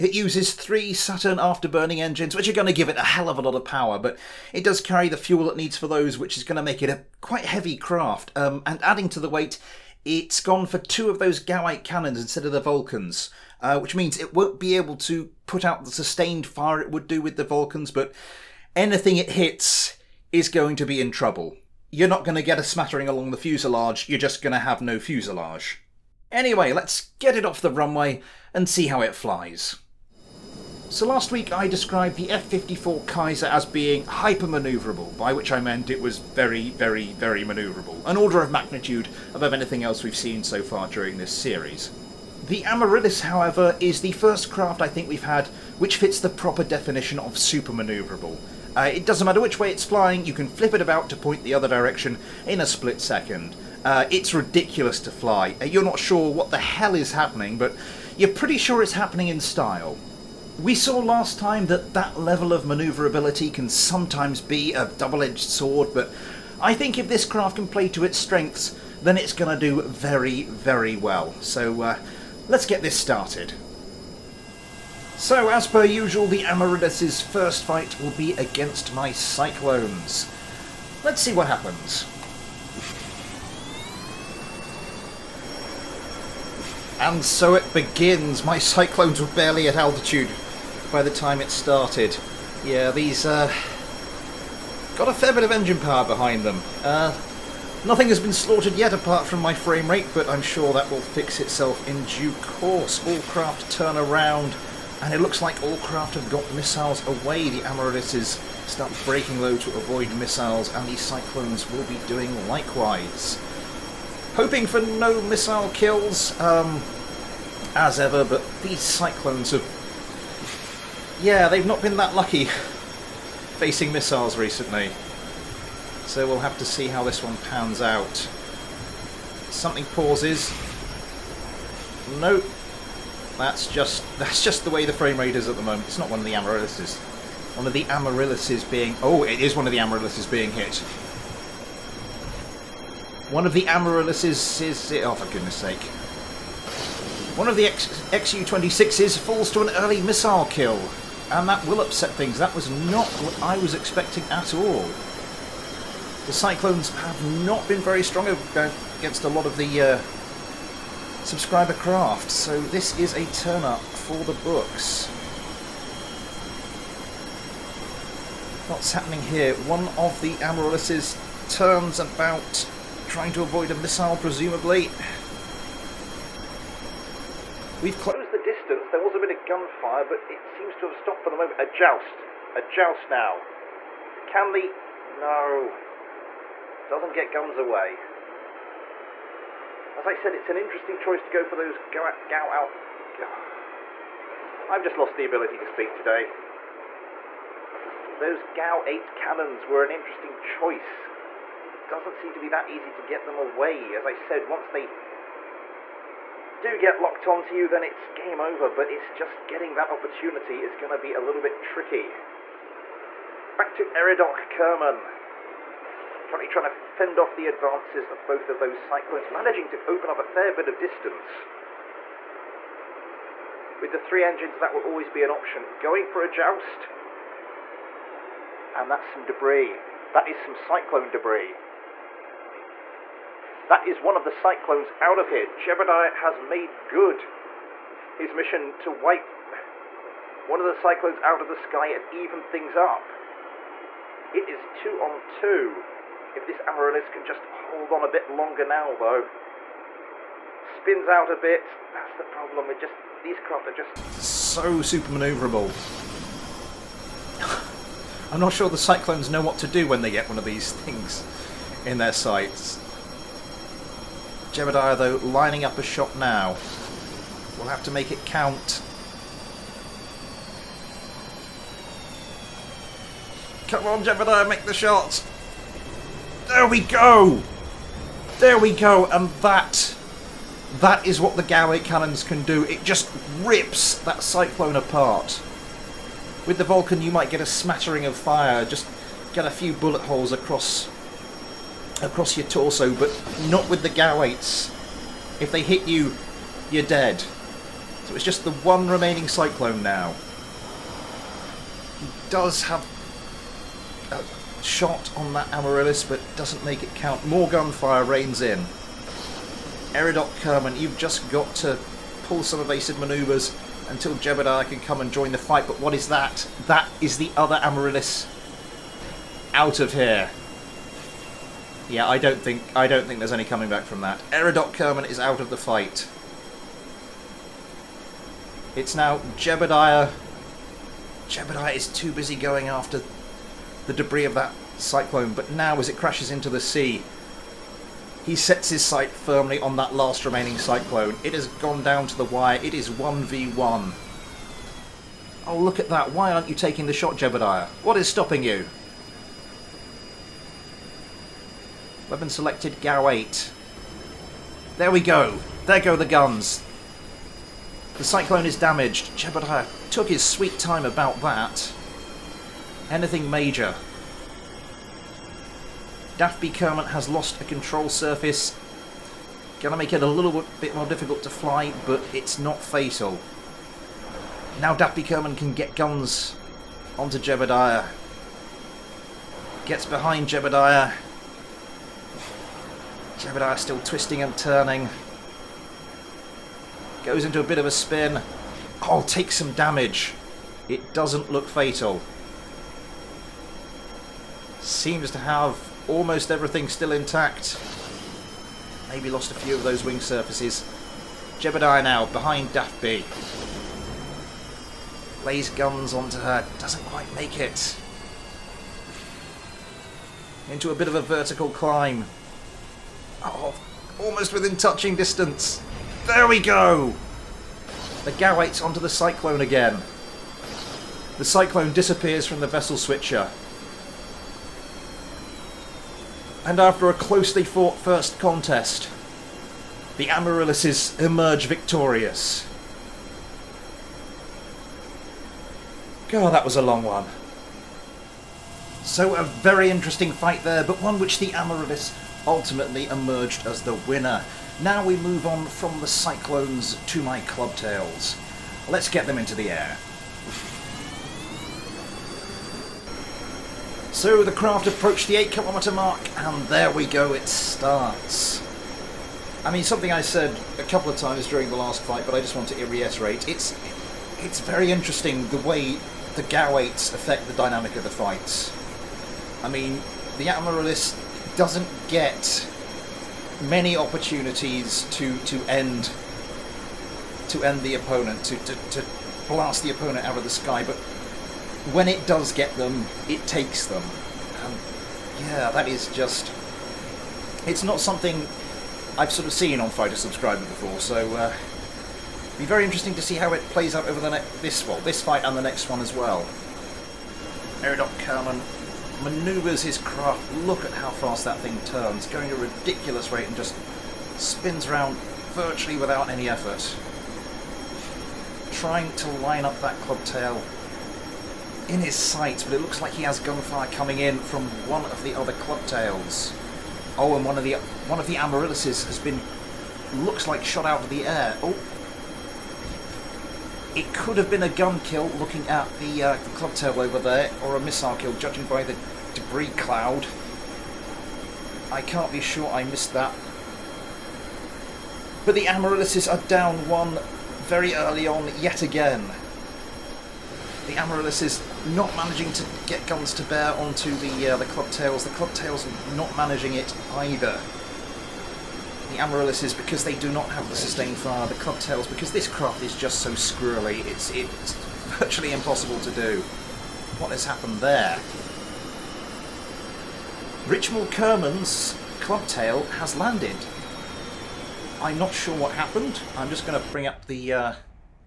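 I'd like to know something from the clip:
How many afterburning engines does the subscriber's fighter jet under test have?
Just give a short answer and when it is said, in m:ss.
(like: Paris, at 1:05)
3, at 0:00.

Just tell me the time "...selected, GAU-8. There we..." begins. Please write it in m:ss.
5:52.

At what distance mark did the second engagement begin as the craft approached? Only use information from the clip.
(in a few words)
8 kilometers.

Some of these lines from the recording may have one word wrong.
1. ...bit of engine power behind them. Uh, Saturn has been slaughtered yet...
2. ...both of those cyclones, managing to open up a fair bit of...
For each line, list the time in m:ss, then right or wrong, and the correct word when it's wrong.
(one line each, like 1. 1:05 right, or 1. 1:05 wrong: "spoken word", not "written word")
1. 1:35 wrong: "Nothing", not "Saturn"
2. 3:38 right.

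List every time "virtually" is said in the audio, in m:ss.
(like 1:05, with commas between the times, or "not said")
8:25, 9:14.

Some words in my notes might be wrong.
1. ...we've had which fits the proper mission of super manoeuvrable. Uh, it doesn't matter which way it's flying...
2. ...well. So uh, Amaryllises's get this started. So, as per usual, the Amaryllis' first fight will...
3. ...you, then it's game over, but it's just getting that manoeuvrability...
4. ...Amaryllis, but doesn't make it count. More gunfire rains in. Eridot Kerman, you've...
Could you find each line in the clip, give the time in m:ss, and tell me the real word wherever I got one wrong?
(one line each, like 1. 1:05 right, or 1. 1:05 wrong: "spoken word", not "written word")
1. 0:45 wrong: "definition", not "mission"
2. 1:10 wrong: "Let", not "Amaryllises"
3. 3:27 wrong: "opportunity", not "manoeuvrability"
4. 5:05 right.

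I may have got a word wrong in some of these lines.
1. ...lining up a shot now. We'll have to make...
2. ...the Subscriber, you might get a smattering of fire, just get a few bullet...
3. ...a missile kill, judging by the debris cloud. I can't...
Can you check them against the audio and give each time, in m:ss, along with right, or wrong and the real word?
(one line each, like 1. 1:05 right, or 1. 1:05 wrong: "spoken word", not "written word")
1. 4:25 right
2. 4:46 wrong: "Vulcan", not "Subscriber"
3. 8:47 right.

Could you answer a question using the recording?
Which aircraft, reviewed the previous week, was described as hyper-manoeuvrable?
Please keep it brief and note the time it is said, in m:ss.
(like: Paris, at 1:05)
F-54 Kaiser, at 0:32.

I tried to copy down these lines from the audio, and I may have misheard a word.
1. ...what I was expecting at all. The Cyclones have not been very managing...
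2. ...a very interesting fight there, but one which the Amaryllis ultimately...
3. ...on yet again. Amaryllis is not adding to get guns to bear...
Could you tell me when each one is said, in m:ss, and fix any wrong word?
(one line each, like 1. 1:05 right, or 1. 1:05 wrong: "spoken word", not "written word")
1. 2:33 wrong: "strong", not "managing"
2. 7:19 right
3. 8:58 wrong: "managing", not "adding".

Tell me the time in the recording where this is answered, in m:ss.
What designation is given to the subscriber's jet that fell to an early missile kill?
2:28.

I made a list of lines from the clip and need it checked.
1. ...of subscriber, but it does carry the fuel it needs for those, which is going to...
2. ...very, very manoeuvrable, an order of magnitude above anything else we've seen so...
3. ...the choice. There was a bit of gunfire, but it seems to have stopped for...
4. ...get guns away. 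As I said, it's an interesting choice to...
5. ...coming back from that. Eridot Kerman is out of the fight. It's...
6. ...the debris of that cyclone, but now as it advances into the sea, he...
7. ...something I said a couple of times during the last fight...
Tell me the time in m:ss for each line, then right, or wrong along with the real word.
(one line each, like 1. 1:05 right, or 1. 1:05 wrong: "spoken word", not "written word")
1. 0:03 wrong: "power", not "subscriber"
2. 0:36 right
3. 2:58 wrong: "distance", not "choice"
4. 3:07 right
5. 5:23 right
6. 5:33 wrong: "crashes", not "advances"
7. 7:39 right.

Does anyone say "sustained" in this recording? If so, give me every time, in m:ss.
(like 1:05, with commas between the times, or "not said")
0:15, 9:10.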